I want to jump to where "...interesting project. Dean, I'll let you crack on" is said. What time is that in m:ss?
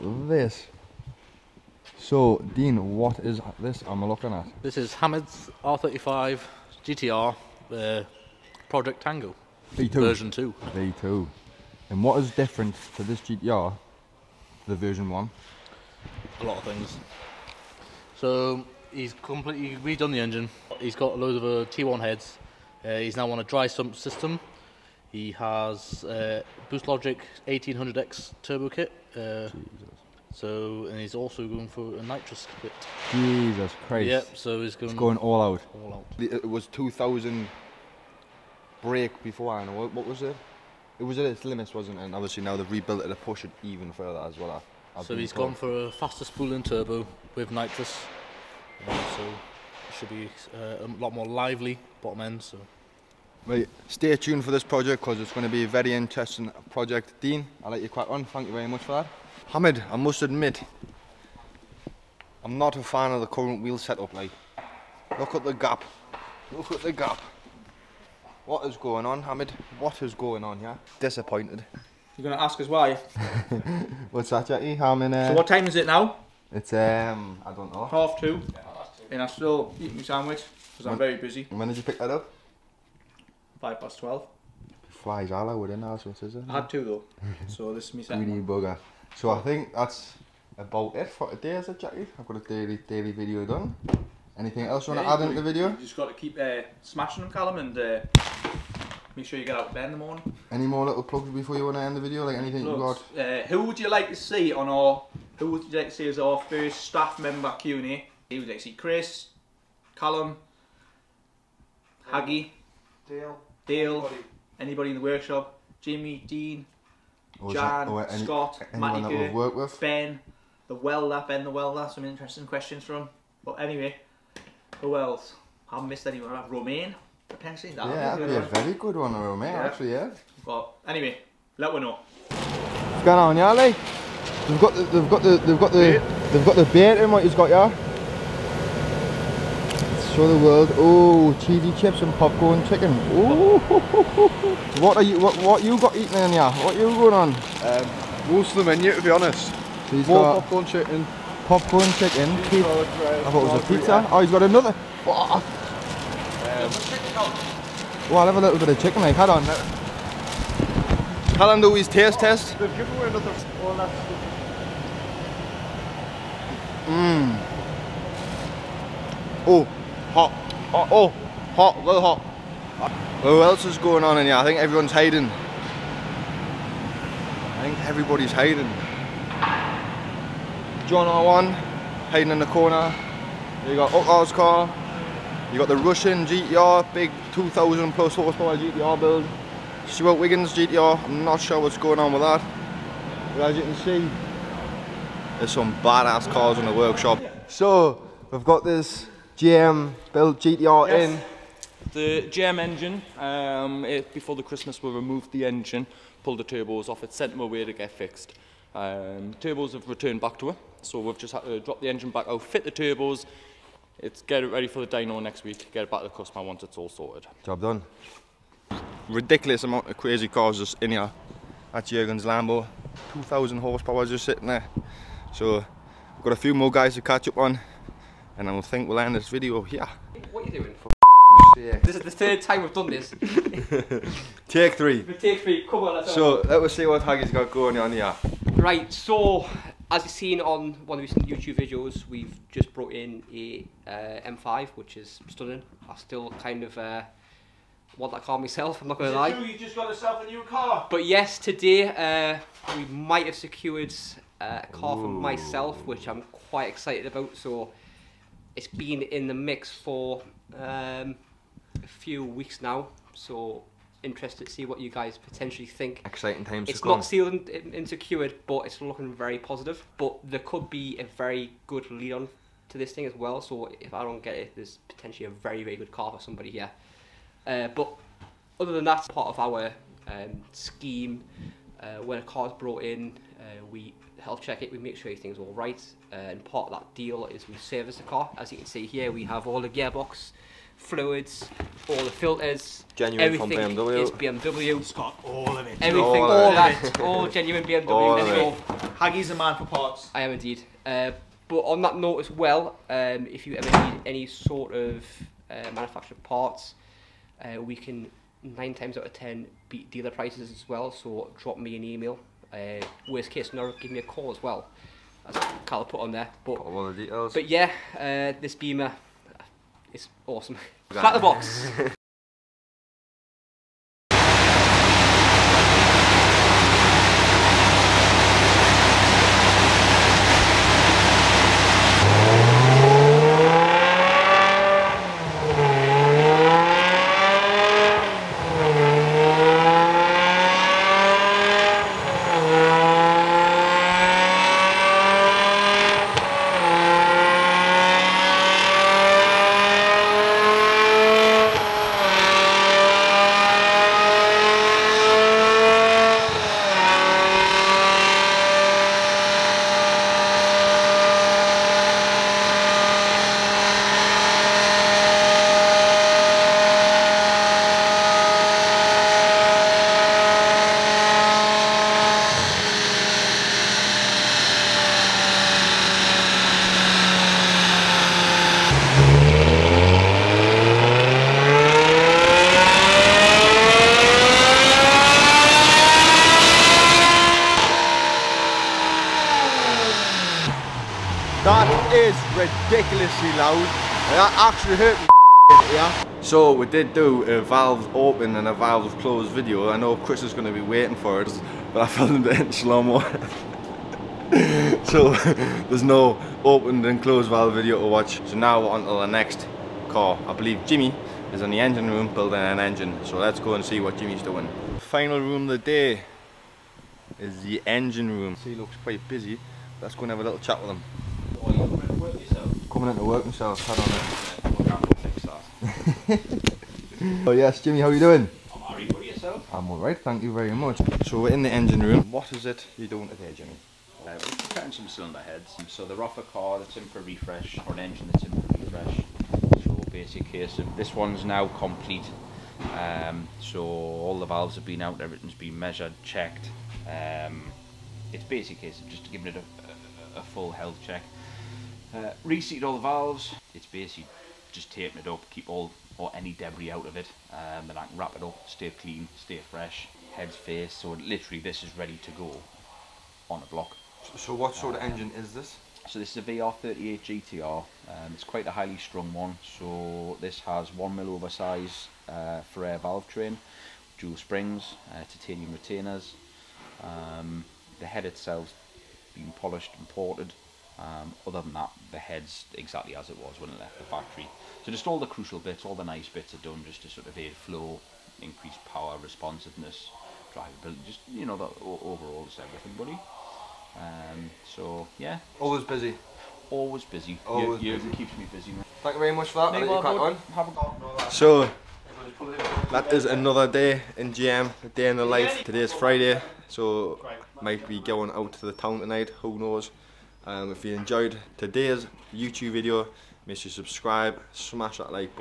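0:55.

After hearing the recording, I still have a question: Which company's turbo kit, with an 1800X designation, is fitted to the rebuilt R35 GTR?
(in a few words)
Boost Logic.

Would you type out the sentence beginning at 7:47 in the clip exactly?
Um, it's quite a highly strung one.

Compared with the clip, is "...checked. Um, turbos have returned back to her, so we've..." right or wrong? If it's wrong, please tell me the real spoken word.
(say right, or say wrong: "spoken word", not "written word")
wrong: "fixed", not "checked".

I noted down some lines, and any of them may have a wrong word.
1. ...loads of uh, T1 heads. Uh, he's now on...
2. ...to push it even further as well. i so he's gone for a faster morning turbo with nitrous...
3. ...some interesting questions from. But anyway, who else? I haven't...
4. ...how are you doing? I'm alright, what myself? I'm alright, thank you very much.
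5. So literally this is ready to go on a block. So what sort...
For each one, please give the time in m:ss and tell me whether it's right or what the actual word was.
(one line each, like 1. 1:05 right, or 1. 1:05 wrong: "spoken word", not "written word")
1. 0:21 right
2. 0:43 wrong: "spooling", not "morning"
3. 2:01 right
4. 7:07 wrong: "yourself", not "myself"
5. 7:40 right.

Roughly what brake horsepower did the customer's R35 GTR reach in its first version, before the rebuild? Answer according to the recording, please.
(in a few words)
2000.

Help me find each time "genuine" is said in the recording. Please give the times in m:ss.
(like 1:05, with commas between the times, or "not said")
4:52, 4:57.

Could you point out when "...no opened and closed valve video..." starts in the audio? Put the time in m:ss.
6:45.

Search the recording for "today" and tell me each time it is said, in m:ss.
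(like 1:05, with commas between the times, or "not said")
1:31, 4:11, 7:13, 8:25, 8:31.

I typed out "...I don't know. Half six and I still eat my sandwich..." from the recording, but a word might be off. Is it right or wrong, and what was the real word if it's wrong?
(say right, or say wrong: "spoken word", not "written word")
wrong: "two", not "six".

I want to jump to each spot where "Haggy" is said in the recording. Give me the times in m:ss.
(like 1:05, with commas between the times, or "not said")
1:52, 3:57, 4:58.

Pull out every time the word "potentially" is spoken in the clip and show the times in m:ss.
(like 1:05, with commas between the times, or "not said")
2:07, 4:25, 4:34.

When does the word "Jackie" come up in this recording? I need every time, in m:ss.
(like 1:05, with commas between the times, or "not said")
1:14, 1:31.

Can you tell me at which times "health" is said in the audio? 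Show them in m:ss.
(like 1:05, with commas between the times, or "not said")
4:44, 7:30.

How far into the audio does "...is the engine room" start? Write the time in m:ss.
6:57.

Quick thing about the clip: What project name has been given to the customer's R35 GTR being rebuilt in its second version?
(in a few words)
Project Tango.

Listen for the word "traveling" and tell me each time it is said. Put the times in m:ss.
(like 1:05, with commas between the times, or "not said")
not said.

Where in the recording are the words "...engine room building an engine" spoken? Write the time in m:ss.
6:51.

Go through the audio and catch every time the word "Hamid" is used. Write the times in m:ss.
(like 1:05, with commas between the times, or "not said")
0:04, 0:59, 1:09.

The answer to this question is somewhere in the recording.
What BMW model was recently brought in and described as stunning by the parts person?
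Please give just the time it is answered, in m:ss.
4:04.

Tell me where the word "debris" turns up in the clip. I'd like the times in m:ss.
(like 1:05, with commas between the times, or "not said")
7:36.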